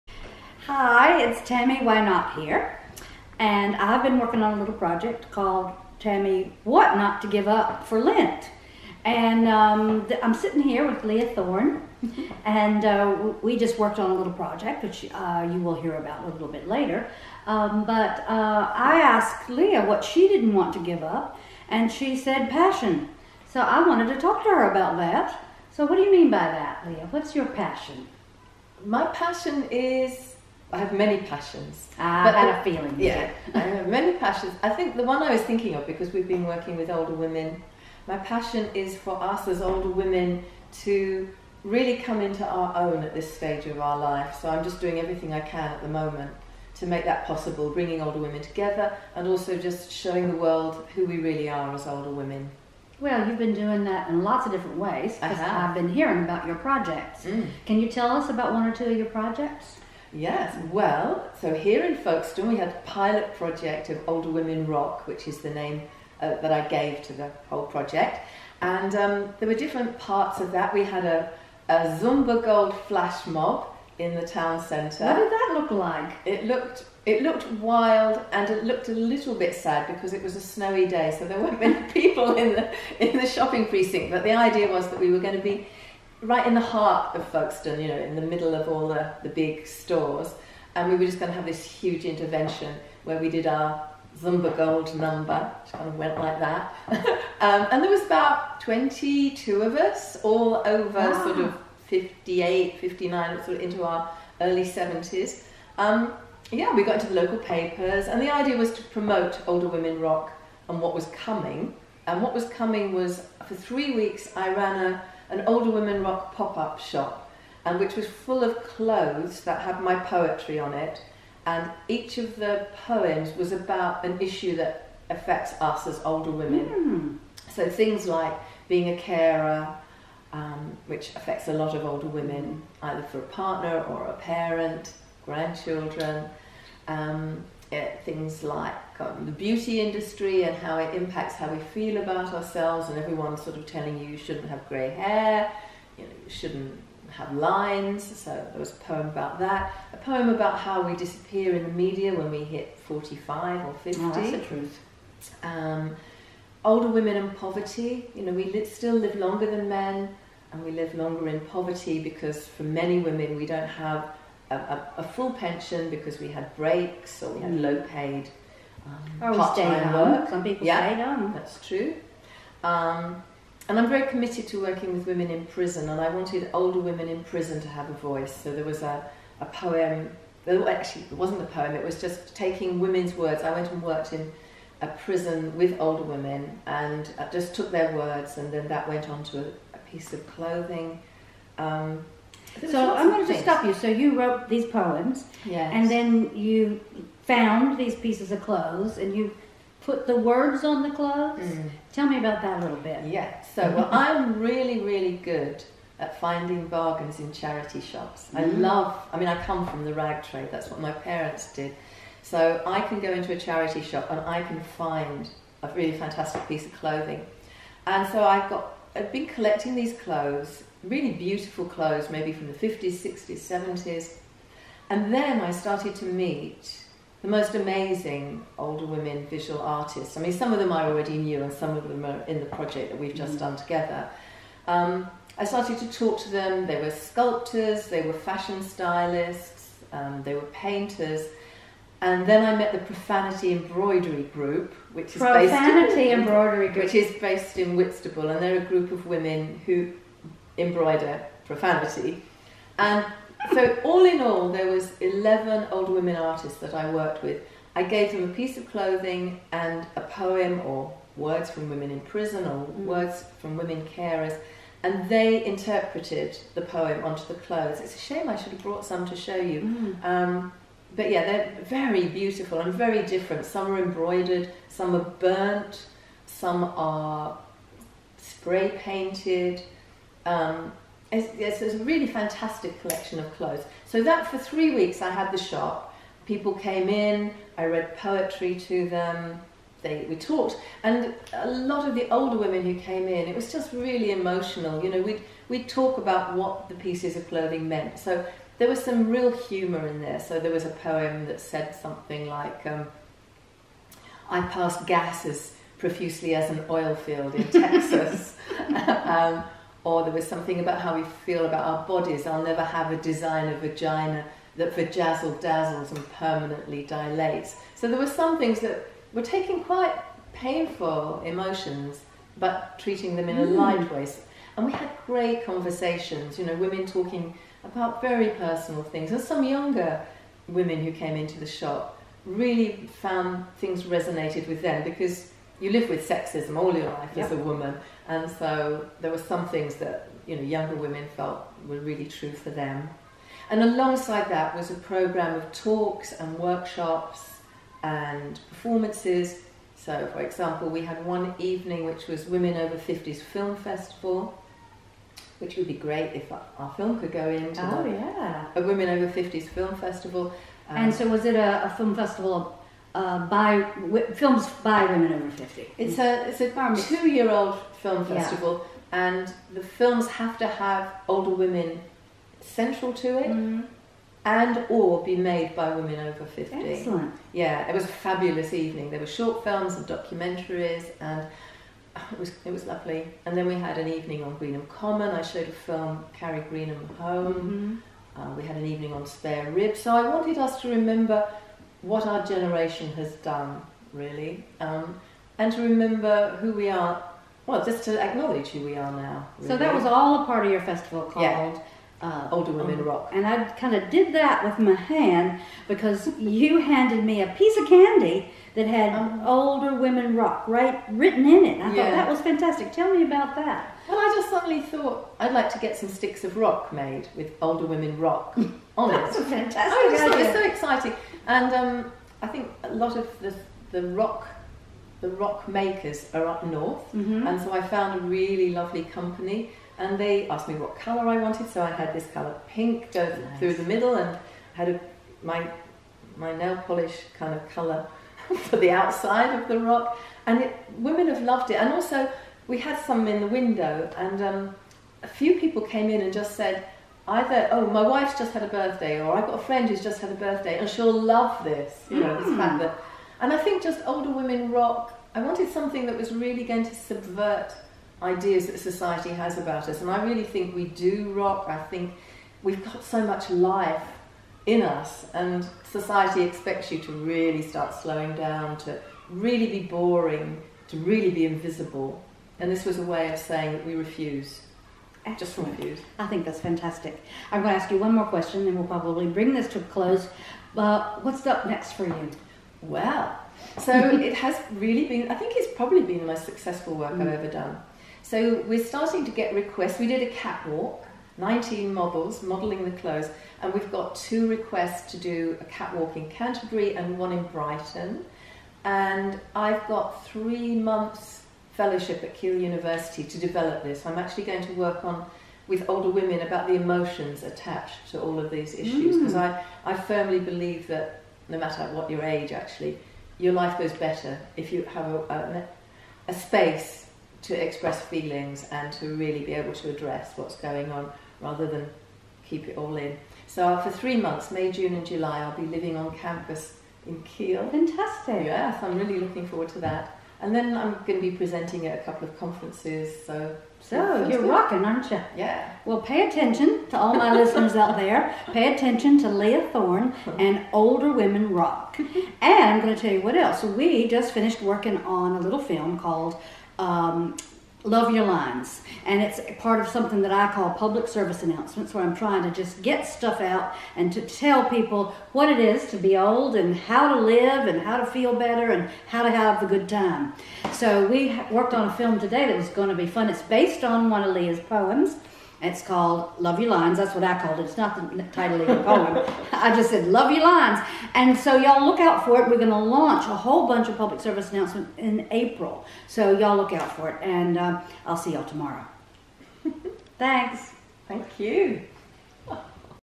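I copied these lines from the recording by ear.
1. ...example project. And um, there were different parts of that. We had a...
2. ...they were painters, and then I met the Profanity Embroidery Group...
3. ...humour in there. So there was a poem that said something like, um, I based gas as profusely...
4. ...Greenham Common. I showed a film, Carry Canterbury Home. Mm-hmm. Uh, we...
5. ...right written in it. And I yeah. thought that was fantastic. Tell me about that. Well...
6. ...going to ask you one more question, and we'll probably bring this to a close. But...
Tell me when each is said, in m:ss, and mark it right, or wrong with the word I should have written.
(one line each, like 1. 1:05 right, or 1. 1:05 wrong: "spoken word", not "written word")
1. 1:07 wrong: "whole", not "example"
2. 4:00 right
3. 4:59 wrong: "passed", not "based"
4. 6:24 wrong: "Greenham", not "Canterbury"
5. 6:50 right
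6. 7:57 right.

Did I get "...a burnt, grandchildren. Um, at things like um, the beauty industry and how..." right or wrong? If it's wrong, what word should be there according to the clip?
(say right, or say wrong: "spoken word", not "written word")
wrong: "parent", not "burnt".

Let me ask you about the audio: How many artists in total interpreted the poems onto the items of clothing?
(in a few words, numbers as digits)
eleven.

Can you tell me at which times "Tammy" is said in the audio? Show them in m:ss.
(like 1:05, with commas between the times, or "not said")
0:01, 0:05.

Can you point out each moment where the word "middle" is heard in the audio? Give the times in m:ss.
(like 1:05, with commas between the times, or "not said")
1:28, 7:13.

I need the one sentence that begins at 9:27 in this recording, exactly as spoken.
It's not the title of the poem.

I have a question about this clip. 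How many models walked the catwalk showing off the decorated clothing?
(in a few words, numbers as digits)
19.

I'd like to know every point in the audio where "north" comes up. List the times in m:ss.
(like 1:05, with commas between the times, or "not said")
7:06.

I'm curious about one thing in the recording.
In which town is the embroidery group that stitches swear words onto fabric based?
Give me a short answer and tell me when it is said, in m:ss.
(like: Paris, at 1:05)
Whitstable, at 4:07.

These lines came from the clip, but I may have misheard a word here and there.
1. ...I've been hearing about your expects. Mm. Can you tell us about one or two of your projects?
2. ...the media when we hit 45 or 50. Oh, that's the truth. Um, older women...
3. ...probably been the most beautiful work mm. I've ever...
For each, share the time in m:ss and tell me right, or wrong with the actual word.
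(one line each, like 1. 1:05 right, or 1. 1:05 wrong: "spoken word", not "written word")
1. 0:55 wrong: "projects", not "expects"
2. 2:31 right
3. 8:05 wrong: "successful", not "beautiful".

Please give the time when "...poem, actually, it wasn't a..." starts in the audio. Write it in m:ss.
2:59.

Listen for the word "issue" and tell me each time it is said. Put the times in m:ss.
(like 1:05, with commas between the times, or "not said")
2:04, 8:28.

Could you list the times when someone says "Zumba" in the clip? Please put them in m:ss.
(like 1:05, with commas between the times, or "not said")
1:12, 1:34.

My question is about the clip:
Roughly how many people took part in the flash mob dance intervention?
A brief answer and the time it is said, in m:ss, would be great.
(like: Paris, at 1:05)
22, at 1:38.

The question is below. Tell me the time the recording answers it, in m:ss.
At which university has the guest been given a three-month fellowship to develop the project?
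8:22.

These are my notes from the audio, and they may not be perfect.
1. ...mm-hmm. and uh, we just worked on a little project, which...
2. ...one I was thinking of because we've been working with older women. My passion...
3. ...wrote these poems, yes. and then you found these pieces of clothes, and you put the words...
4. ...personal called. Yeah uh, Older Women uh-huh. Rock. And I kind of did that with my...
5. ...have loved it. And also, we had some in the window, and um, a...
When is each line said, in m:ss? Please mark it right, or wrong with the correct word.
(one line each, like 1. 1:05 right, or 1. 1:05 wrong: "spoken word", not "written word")
1. 0:12 right
2. 0:35 right
3. 3:14 right
4. 6:40 wrong: "festival", not "personal"
5. 7:21 right.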